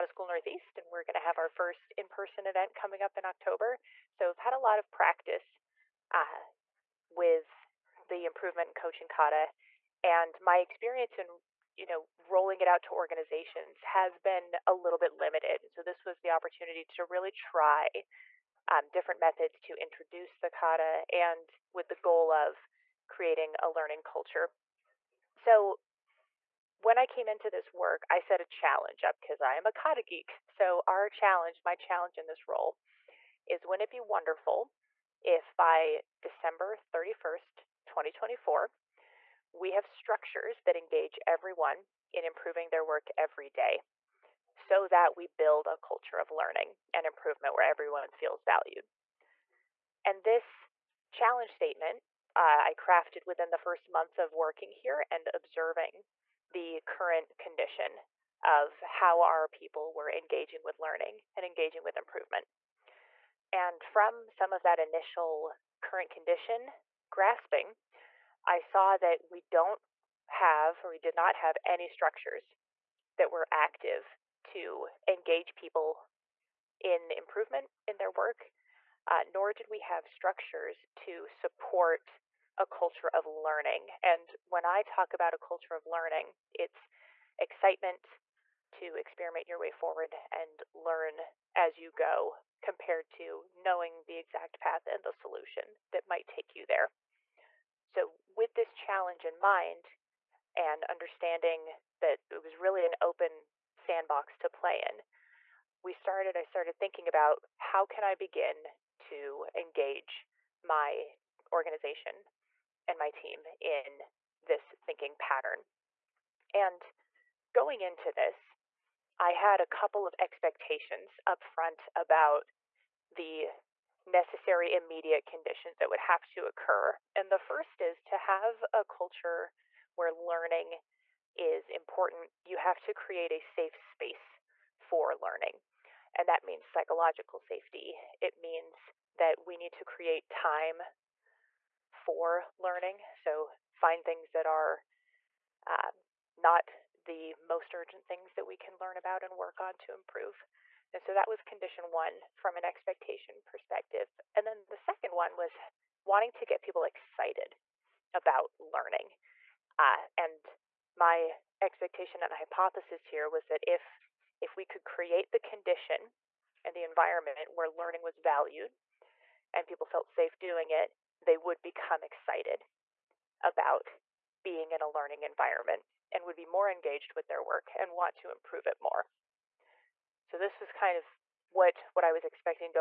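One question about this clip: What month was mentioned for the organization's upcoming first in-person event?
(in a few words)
October.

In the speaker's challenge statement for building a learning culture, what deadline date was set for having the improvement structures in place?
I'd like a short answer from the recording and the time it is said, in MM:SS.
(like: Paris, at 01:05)
December 31st, 2024, at 00:36.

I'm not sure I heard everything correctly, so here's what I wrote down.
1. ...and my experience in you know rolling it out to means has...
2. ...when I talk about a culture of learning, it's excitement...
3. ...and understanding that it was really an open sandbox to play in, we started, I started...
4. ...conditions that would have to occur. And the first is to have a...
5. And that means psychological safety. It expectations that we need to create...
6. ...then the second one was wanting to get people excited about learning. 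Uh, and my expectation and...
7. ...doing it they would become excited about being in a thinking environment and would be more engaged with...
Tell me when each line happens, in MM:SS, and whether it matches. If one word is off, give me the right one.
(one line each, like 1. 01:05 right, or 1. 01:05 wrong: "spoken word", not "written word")
1. 00:10 wrong: "organizations", not "means"
2. 01:24 right
3. 01:40 right
4. 02:05 right
5. 02:16 wrong: "means", not "expectations"
6. 02:34 right
7. 02:50 wrong: "learning", not "thinking".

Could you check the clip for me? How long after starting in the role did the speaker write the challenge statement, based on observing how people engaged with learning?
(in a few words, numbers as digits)
first month.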